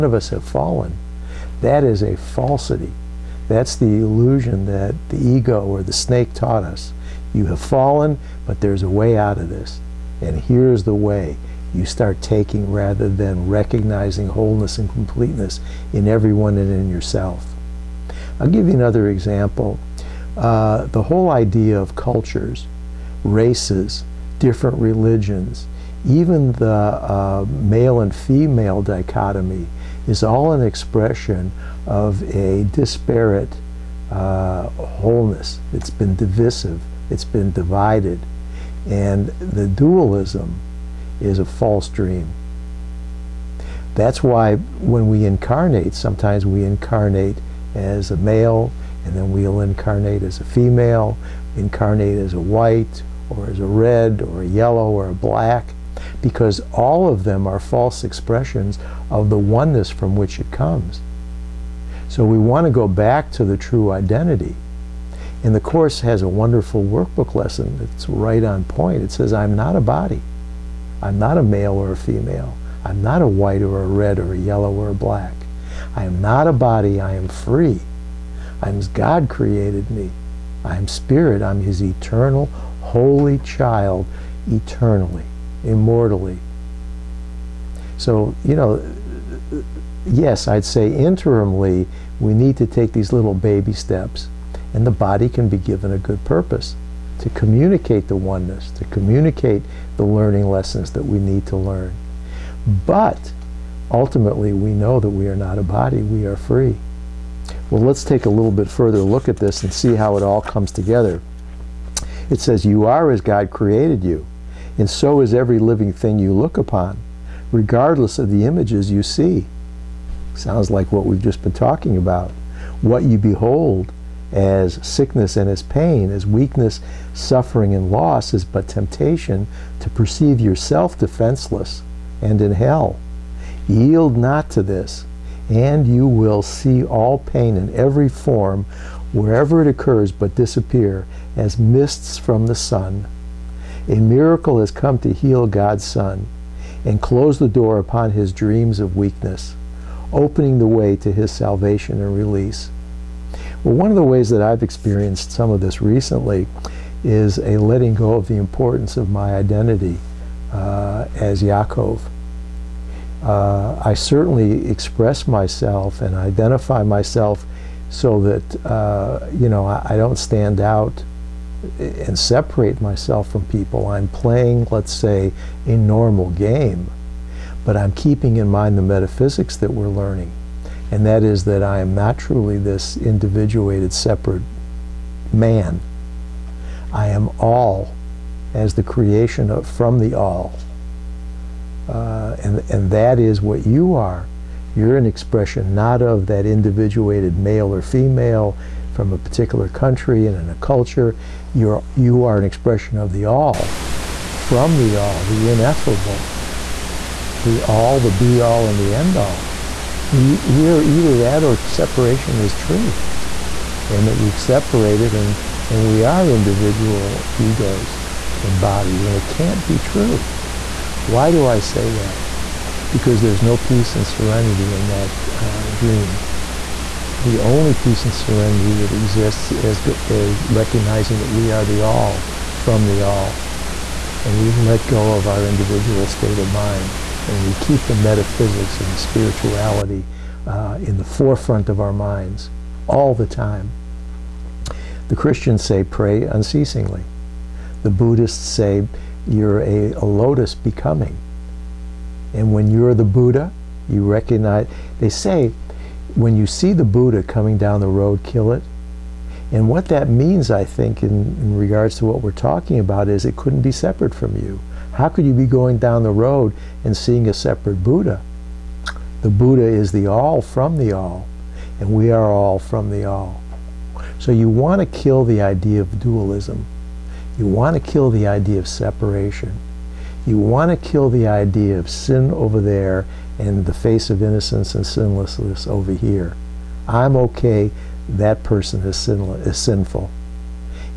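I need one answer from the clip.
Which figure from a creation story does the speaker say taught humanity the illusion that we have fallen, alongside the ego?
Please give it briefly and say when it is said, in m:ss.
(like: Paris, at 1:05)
The snake, at 0:05.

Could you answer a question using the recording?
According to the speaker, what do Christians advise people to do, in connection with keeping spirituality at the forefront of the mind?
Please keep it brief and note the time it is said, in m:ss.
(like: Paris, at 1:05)
Pray unceasingly, at 4:05.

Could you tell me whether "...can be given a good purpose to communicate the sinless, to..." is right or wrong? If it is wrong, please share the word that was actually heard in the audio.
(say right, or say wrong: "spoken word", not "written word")
wrong: "oneness", not "sinless".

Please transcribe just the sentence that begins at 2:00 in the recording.
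Sounds like what we've just been talking about.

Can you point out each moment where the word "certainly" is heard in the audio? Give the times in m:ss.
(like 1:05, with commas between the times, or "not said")
2:43.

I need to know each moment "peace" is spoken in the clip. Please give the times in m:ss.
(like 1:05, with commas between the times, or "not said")
3:43, 3:47.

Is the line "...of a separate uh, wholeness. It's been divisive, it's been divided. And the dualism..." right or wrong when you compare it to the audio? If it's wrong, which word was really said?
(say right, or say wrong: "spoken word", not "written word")
wrong: "disparate", not "separate".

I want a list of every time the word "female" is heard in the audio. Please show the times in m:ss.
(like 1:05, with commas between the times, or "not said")
0:28, 0:50, 1:11, 3:17.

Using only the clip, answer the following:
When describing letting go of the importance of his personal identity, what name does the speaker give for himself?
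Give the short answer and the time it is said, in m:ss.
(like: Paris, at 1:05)
Yaakov, at 2:41.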